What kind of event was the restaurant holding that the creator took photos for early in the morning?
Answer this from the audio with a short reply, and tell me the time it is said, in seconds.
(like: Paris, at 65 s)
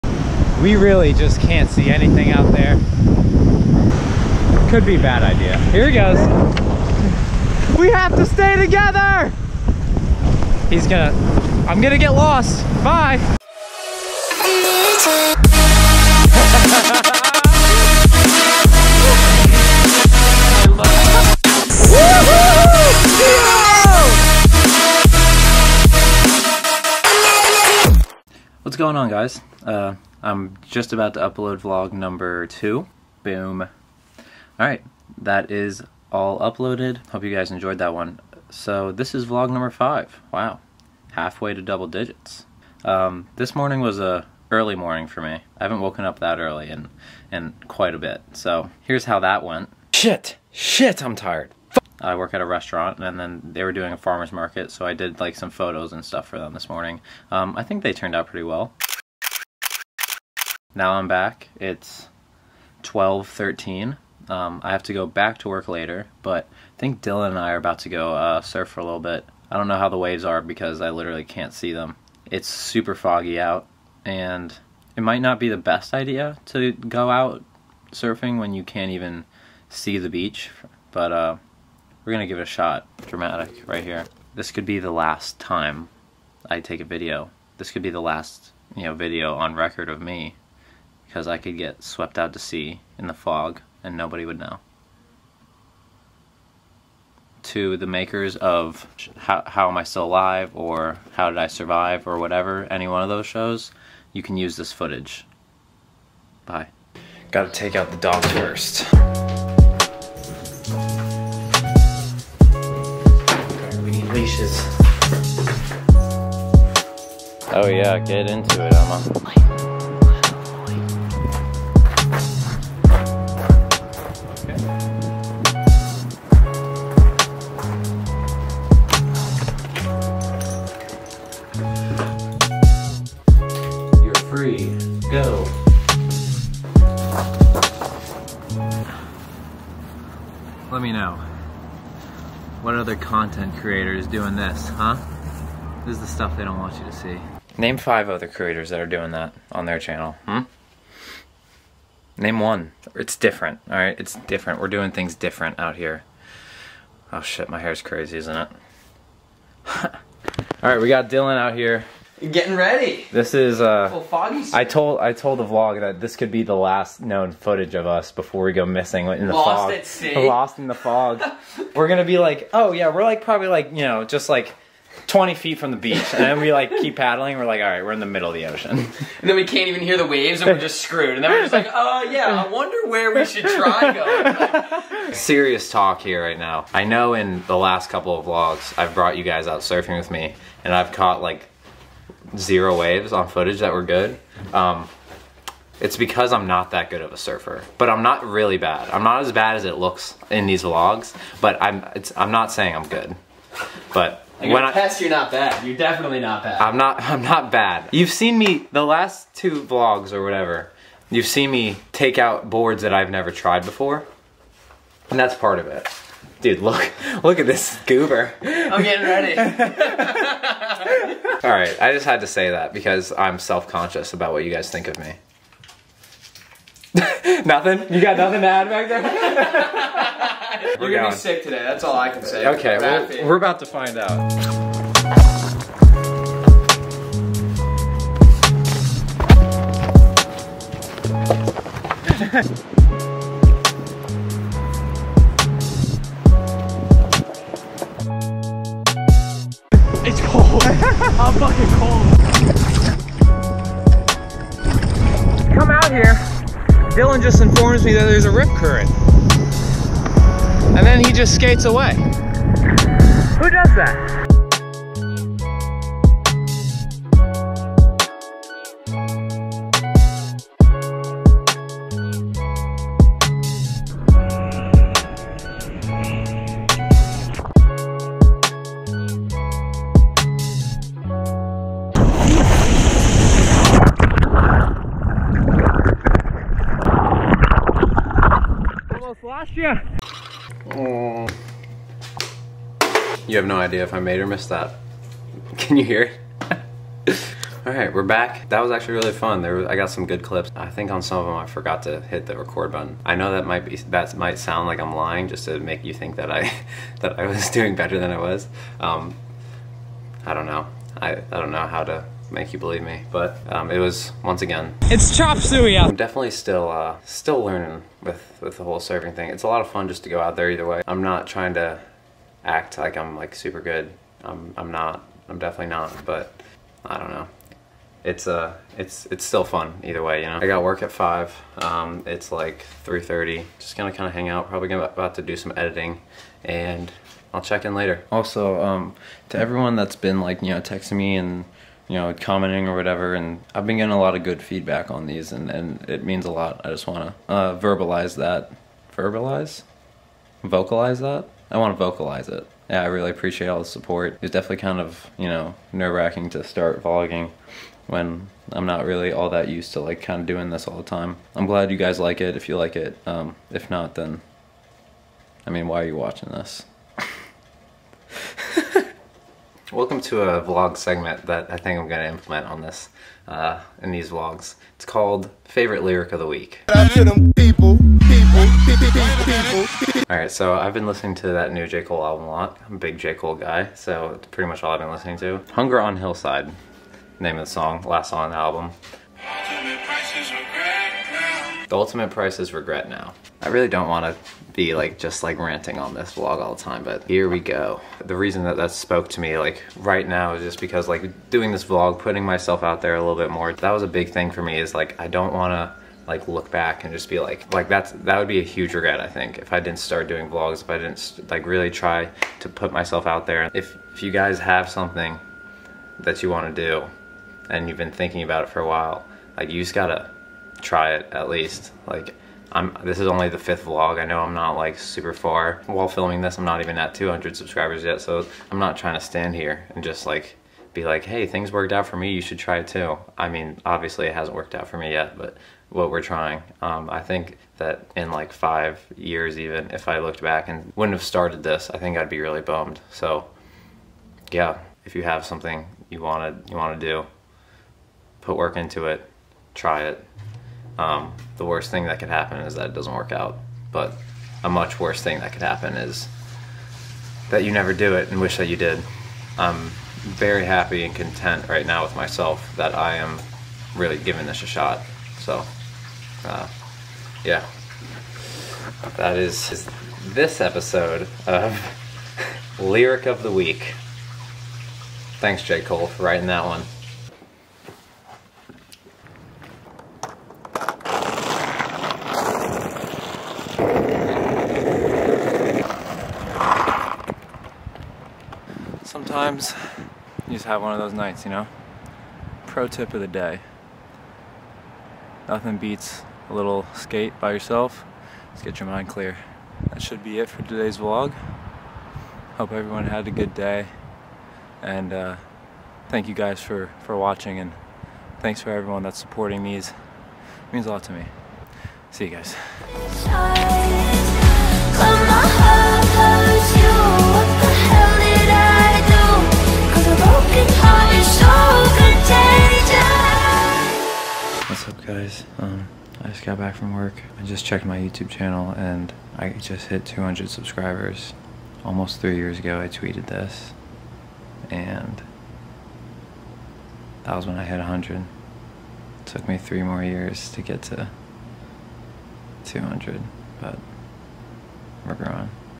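farmer's market, at 53 s.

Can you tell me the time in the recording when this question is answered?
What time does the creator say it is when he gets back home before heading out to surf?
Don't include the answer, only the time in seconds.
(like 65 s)
62 s.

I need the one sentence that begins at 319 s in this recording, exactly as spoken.
It's a lot of fun just to go out there either way.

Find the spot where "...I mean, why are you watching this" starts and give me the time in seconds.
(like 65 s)
365 s.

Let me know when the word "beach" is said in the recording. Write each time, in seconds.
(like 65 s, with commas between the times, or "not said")
80 s, 175 s.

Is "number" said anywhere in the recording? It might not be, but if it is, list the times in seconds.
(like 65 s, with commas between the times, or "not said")
31 s, 39 s.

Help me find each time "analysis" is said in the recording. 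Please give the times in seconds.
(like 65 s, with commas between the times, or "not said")
not said.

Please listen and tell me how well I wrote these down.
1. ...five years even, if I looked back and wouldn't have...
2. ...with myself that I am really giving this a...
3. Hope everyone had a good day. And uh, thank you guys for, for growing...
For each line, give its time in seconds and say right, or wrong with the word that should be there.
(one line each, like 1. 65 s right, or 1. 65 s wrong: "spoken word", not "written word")
1. 438 s right
2. 461 s right
3. 502 s wrong: "watching", not "growing".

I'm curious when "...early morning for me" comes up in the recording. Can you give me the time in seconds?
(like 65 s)
44 s.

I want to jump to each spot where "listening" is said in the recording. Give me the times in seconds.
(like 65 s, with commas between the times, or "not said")
380 s, 384 s.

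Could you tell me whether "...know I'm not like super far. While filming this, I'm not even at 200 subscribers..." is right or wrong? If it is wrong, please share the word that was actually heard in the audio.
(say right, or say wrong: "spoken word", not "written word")
right.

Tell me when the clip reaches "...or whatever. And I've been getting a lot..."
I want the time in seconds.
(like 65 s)
342 s.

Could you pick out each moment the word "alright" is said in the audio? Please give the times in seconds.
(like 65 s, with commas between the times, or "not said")
34 s, 153 s, 160 s, 380 s.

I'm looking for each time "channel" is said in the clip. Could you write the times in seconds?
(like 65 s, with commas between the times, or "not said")
149 s, 528 s.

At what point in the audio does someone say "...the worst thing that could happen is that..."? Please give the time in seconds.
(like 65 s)
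451 s.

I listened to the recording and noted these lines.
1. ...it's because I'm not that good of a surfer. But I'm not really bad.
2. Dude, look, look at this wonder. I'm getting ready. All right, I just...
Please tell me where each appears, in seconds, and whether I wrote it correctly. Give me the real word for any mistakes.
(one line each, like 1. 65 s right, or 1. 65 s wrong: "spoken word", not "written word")
1. 195 s right
2. 216 s wrong: "goober", not "wonder".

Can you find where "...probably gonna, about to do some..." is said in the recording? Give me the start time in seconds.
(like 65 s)
334 s.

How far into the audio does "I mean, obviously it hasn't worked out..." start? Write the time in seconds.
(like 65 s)
433 s.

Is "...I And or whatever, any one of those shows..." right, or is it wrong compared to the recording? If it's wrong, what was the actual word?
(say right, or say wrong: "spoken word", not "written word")
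wrong: "Survive", not "And".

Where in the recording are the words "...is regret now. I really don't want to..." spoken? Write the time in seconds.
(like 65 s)
392 s.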